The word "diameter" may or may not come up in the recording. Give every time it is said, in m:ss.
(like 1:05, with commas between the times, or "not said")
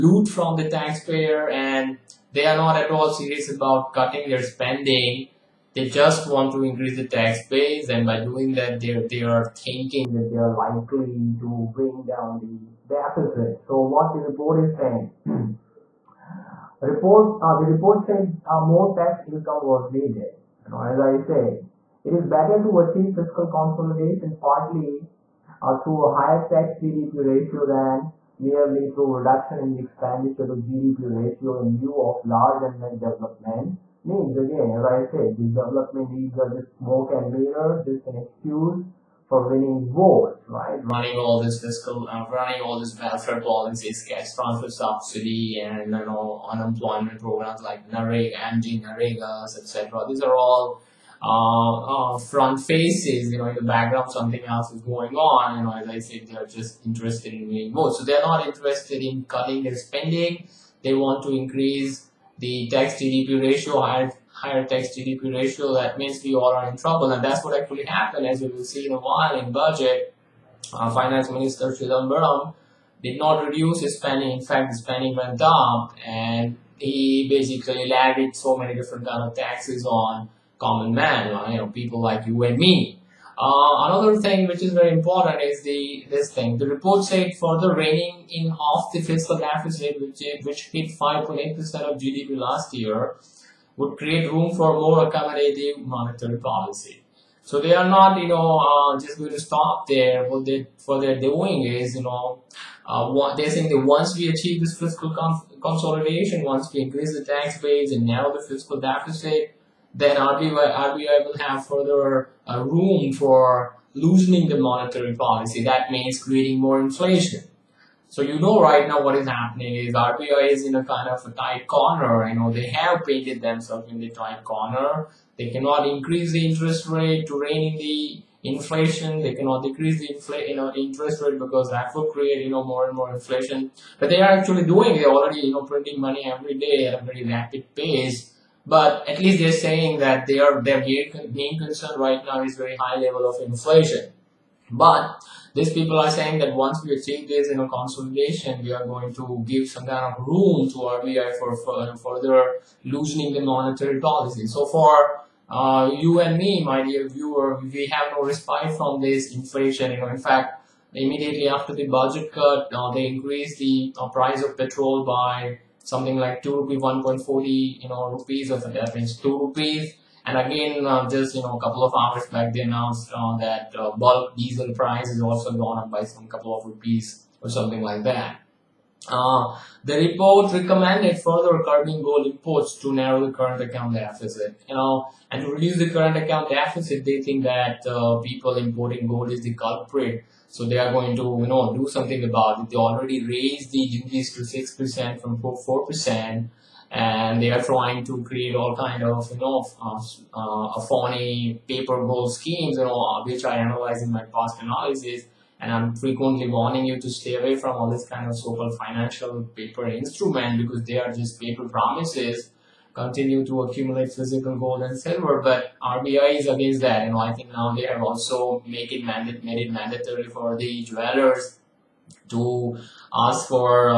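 not said.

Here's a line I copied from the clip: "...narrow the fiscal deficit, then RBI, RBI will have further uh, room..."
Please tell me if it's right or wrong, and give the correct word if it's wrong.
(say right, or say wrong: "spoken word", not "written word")
right.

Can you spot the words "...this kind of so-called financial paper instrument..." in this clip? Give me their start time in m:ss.
3:27.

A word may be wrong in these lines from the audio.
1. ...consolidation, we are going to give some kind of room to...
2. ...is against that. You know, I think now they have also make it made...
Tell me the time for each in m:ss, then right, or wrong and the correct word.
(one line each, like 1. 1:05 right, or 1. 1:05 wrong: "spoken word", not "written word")
1. 2:27 right
2. 3:36 right.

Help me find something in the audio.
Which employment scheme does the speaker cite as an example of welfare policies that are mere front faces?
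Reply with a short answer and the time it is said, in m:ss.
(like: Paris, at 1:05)
NAREGA, at 0:47.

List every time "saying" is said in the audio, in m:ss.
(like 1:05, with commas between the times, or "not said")
0:14, 1:43, 2:19, 2:26.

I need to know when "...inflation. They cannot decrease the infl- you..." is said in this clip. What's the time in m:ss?
2:08.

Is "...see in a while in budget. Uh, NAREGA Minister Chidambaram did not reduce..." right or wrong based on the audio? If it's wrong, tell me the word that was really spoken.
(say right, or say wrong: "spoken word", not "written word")
wrong: "Finance", not "NAREGA".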